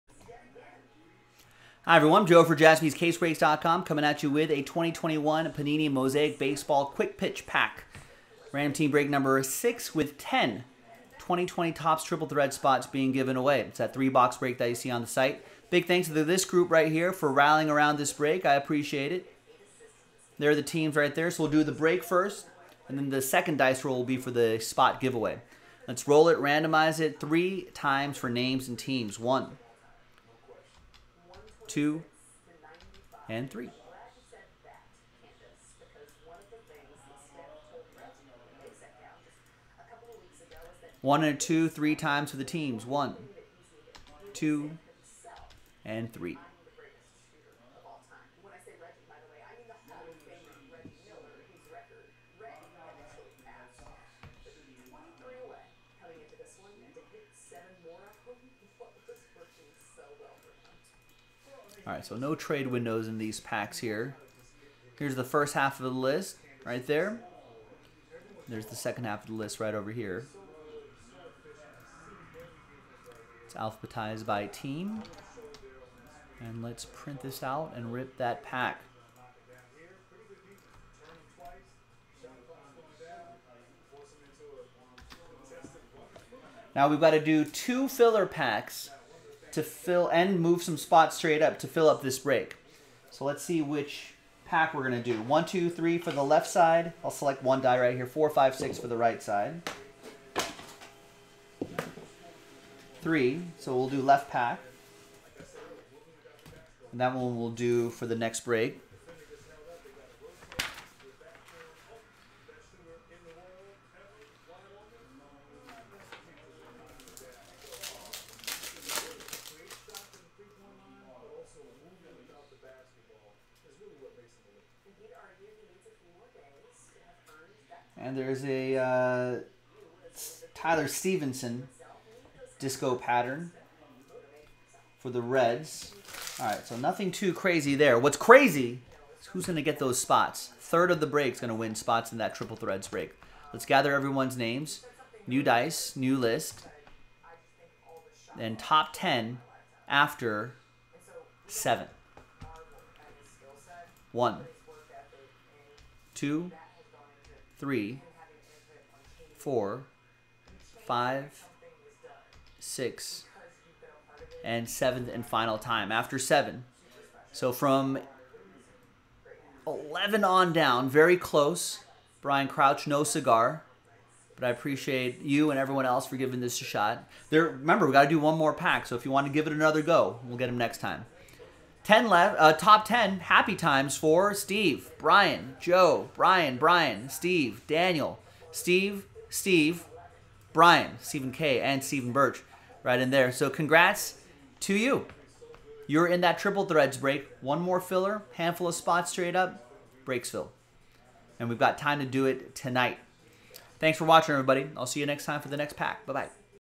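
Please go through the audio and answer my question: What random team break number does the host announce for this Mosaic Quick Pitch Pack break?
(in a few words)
6.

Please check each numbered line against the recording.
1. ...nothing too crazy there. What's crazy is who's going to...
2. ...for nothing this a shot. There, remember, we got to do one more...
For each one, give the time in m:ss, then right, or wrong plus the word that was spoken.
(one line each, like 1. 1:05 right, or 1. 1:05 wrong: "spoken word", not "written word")
1. 2:16 right
2. 2:56 wrong: "giving", not "nothing".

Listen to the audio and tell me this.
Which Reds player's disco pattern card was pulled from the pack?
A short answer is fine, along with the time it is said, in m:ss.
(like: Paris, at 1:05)
Tyler Stephenson, at 2:10.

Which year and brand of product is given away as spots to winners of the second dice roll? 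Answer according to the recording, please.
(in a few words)
2020 Topps Triple Thread.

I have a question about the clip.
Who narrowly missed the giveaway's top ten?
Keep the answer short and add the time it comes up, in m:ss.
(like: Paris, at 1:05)
Brian Crouch, at 2:52.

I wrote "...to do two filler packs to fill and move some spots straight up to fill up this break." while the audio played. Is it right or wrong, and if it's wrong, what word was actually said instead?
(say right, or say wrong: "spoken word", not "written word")
right.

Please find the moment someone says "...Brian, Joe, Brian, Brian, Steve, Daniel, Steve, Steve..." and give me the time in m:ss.
3:04.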